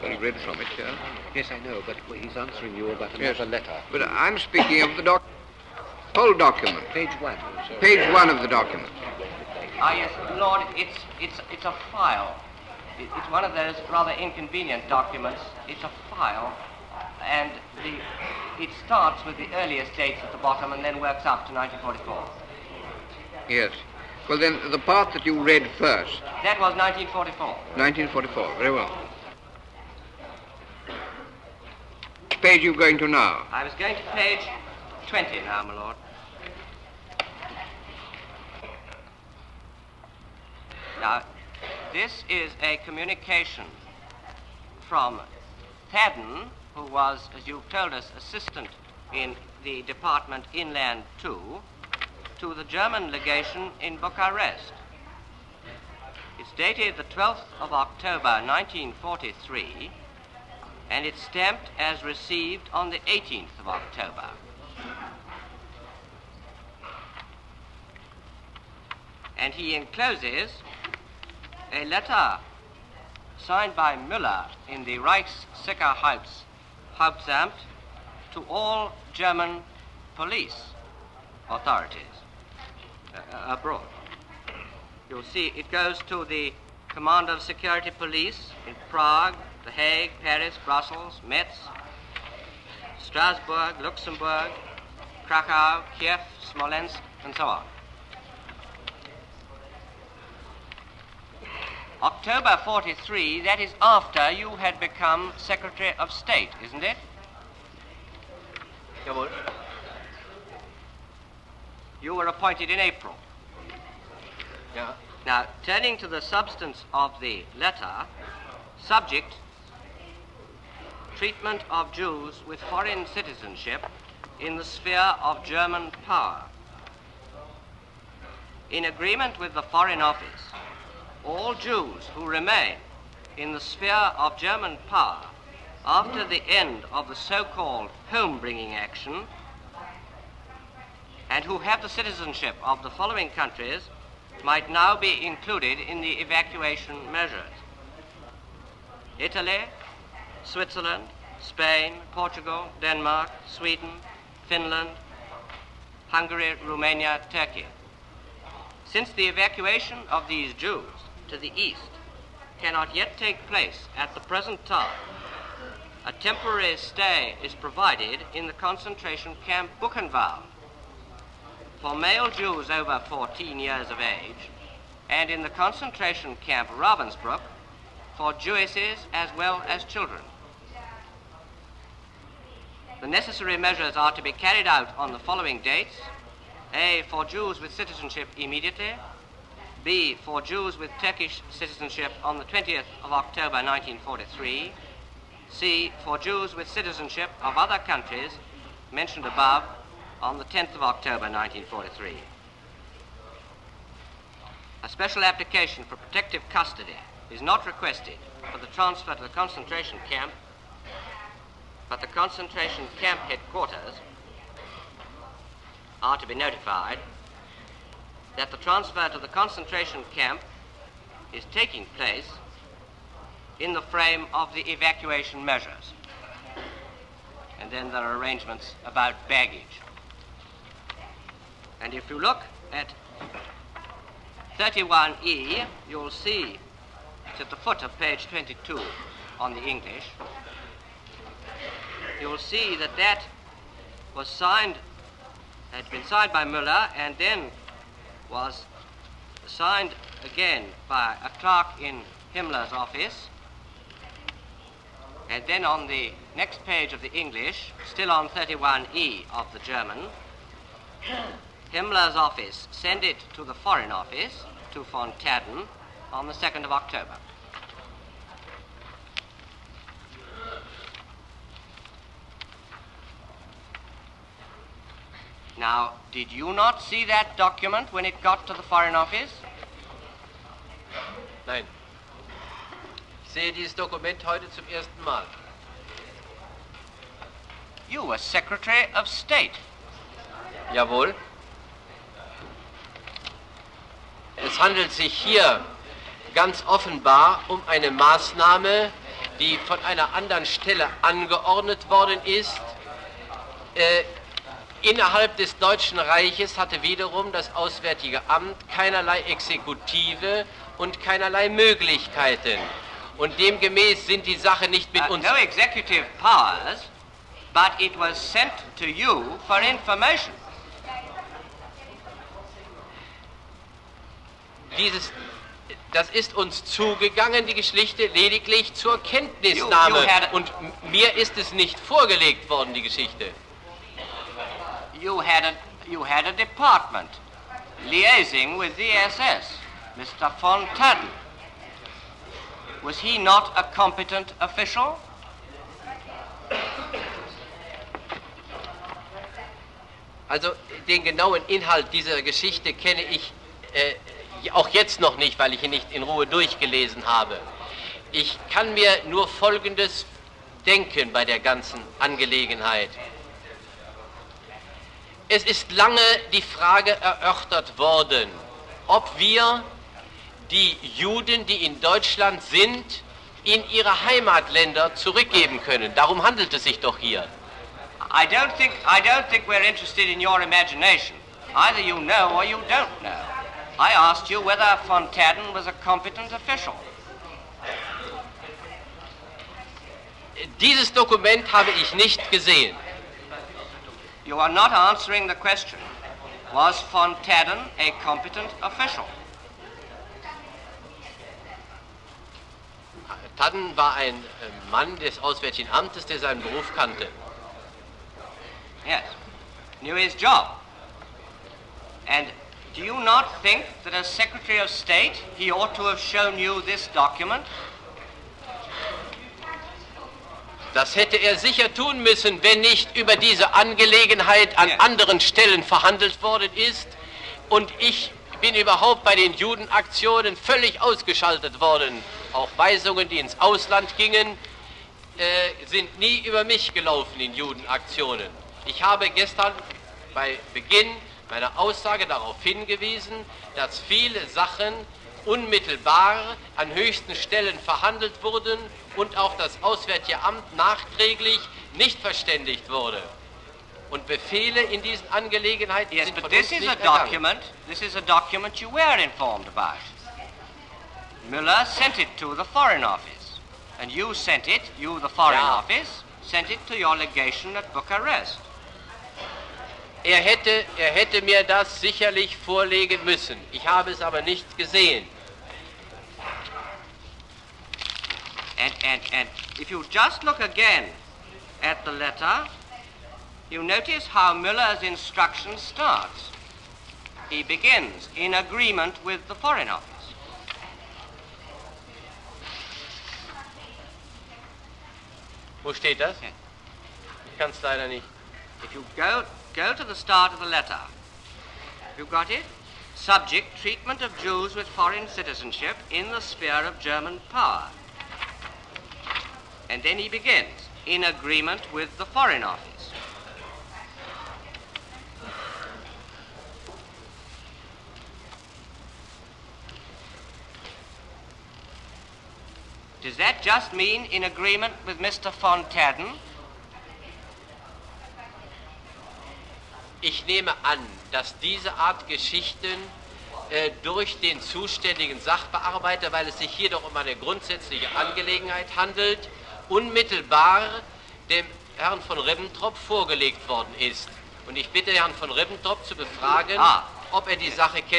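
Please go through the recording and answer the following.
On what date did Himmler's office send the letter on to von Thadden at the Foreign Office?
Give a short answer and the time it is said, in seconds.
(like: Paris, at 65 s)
2nd of October, at 266 s.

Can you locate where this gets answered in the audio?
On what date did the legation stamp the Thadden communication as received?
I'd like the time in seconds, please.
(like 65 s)
63 s.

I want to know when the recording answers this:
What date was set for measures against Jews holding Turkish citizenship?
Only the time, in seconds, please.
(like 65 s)
192 s.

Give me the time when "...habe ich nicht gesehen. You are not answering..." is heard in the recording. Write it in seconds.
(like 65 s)
391 s.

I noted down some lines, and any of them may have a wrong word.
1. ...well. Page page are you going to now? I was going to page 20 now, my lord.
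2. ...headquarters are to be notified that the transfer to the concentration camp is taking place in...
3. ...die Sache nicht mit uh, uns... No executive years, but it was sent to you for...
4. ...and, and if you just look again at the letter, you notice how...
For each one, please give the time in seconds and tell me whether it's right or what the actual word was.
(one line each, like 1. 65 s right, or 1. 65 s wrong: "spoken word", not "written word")
1. 28 s right
2. 213 s right
3. 314 s wrong: "powers", not "years"
4. 478 s right.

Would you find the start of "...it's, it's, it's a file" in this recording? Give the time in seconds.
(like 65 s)
10 s.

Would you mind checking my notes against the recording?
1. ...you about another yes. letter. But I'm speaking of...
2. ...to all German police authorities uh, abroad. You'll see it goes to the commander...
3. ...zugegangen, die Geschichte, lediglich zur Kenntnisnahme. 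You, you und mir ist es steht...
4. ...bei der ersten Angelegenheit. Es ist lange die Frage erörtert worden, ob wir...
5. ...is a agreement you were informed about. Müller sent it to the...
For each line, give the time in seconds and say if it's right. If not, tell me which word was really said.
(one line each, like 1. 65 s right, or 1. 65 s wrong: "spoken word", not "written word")
1. 2 s right
2. 78 s right
3. 326 s wrong: "nicht", not "steht"
4. 361 s wrong: "ganzen", not "ersten"
5. 457 s wrong: "document", not "agreement".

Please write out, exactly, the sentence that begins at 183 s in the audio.
The necessary measures are to be carried out on the following dates.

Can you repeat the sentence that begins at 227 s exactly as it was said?
And then there are arrangements about baggage.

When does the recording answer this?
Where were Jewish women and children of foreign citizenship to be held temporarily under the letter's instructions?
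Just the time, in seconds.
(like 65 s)
176 s.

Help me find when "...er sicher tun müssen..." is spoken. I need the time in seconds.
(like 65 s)
421 s.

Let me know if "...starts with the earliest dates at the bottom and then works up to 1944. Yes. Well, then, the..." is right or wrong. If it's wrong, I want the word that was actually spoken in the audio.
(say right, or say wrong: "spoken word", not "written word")
right.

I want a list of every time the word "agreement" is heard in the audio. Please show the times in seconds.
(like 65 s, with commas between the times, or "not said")
128 s, 488 s, 511 s, 524 s.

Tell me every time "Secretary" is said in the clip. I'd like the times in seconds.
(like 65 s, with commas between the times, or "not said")
105 s, 288 s, 414 s.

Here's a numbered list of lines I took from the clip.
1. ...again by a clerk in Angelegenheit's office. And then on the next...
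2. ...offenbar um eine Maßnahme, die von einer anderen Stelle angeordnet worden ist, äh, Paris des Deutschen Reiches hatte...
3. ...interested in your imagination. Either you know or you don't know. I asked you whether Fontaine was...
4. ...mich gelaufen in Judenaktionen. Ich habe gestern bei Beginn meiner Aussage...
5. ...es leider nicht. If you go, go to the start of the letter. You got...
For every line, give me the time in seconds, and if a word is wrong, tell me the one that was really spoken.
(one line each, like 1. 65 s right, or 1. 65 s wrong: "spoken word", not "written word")
1. 250 s wrong: "Himmler", not "Angelegenheit"
2. 296 s wrong: "Innerhalb", not "Paris"
3. 379 s right
4. 436 s right
5. 497 s right.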